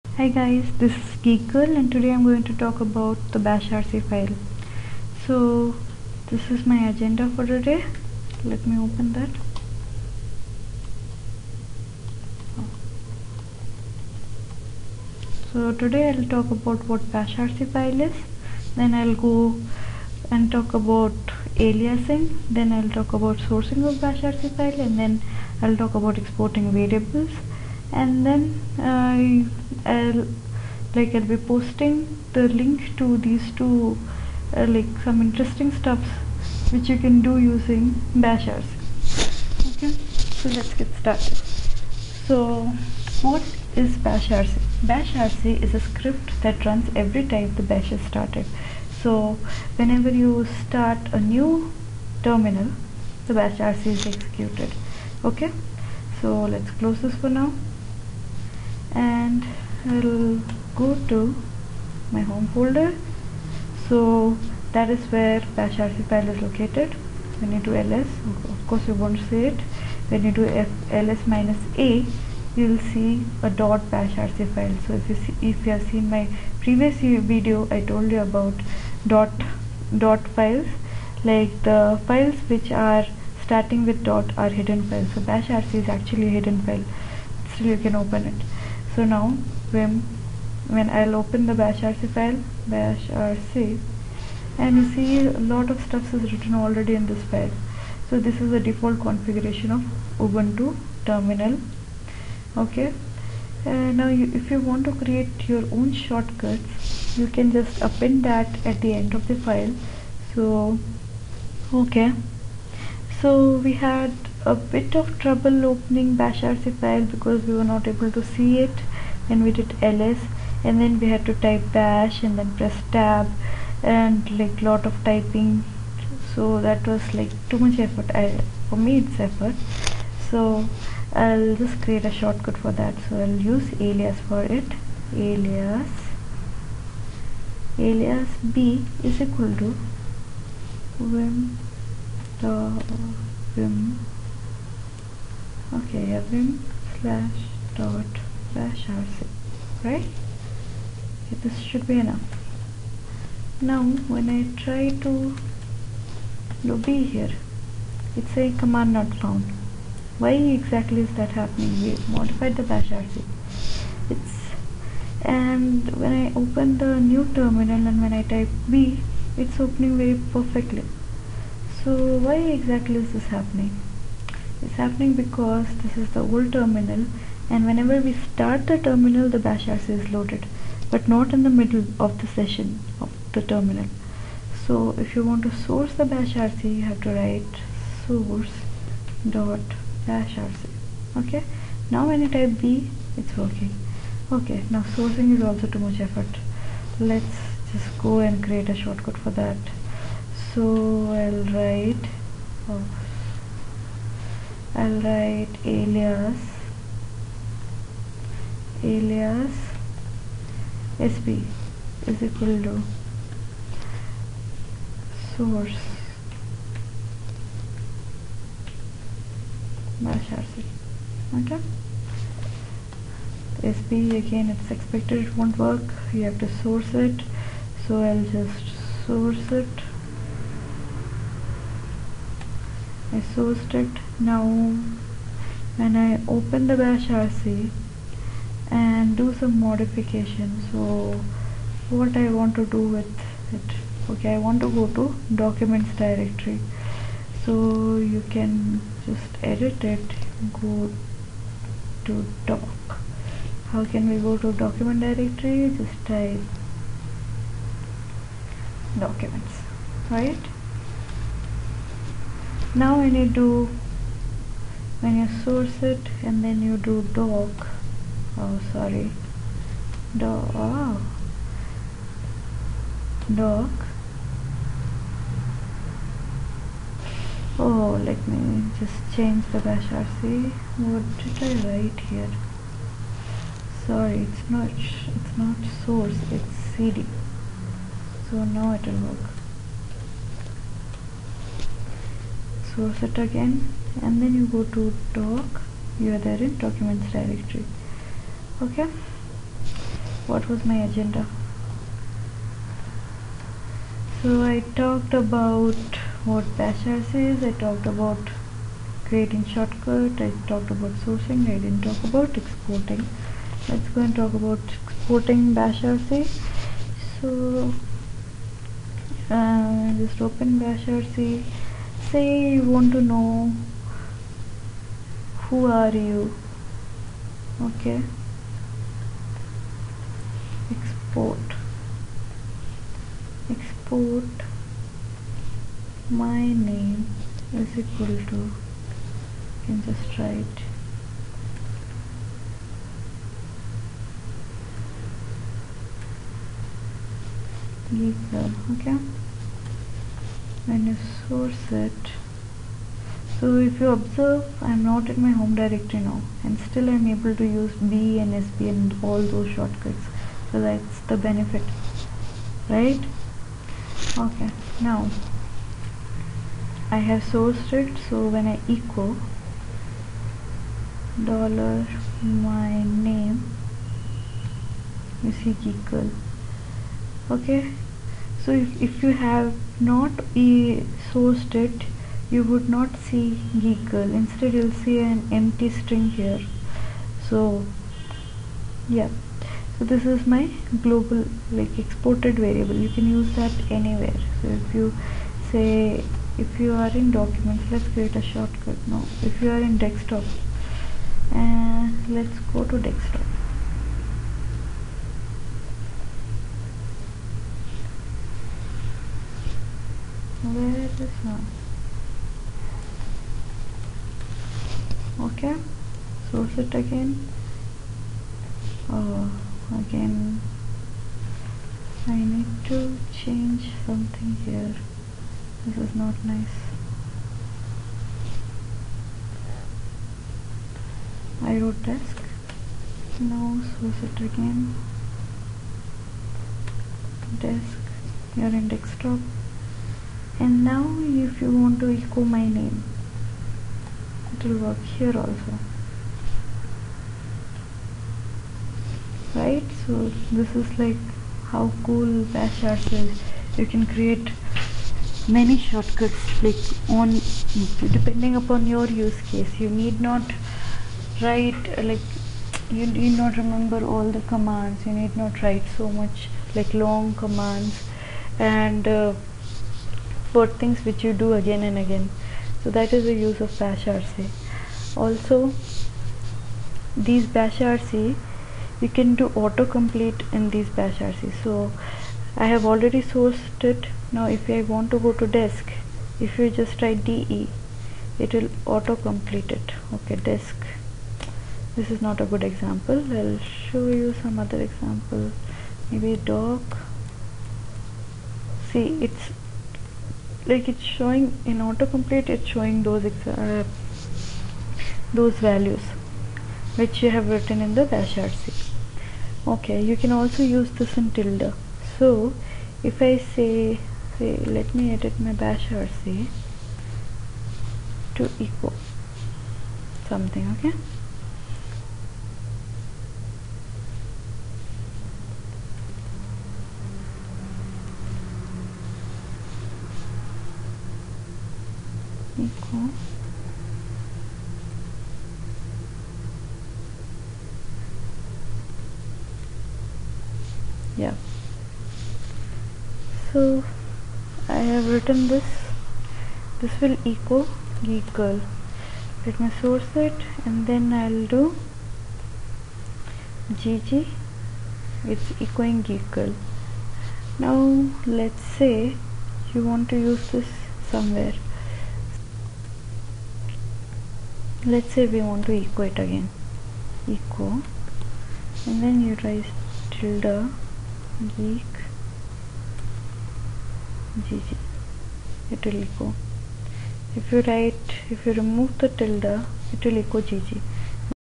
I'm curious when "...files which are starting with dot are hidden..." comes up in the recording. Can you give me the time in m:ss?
1:22.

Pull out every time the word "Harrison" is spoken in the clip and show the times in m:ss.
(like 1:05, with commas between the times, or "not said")
not said.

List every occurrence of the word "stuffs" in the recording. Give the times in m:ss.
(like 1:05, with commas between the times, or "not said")
0:35, 1:35.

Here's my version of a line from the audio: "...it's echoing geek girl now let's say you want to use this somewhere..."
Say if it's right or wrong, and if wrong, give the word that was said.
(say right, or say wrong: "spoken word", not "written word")
right.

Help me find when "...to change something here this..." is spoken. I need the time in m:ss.
7:02.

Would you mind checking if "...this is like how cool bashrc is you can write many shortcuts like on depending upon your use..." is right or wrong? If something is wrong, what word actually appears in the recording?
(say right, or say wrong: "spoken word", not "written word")
wrong: "create", not "write".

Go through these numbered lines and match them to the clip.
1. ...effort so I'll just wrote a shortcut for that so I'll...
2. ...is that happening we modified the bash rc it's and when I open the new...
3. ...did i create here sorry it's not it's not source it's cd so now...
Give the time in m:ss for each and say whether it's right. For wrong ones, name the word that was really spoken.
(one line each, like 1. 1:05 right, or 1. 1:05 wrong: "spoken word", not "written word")
1. 2:09 wrong: "create", not "wrote"
2. 2:41 right
3. 4:41 wrong: "write", not "create".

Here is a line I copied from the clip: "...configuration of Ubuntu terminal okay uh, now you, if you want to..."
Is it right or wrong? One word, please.
right.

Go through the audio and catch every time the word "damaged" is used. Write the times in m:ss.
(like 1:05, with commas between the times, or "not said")
not said.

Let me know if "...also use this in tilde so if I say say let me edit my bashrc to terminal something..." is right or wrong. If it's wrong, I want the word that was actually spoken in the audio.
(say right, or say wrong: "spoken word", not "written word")
wrong: "equal", not "terminal".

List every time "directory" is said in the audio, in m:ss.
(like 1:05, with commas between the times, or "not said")
4:05, 4:15, 4:57, 5:55.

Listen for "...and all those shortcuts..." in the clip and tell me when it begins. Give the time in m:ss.
5:58.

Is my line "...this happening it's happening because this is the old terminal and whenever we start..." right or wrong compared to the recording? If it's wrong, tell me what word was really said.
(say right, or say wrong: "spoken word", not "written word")
right.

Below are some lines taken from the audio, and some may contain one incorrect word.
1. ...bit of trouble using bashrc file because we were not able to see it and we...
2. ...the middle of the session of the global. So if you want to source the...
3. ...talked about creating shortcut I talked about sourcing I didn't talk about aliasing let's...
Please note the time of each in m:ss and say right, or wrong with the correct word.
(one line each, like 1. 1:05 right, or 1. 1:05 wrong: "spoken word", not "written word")
1. 1:54 wrong: "opening", not "using"
2. 3:01 wrong: "terminal", not "global"
3. 5:07 wrong: "exporting", not "aliasing".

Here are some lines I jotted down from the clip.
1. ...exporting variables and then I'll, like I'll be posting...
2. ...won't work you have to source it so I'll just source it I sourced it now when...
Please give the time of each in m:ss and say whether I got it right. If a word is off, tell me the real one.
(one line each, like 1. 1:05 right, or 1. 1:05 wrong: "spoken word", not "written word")
1. 0:26 right
2. 3:45 right.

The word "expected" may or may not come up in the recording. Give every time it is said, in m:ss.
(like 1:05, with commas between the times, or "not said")
3:44.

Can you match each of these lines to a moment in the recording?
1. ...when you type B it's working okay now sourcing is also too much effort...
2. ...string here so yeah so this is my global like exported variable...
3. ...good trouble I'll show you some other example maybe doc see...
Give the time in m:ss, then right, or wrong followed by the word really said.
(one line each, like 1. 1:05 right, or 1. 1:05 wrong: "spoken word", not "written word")
1. 3:12 right
2. 6:25 right
3. 8:12 wrong: "example", not "trouble".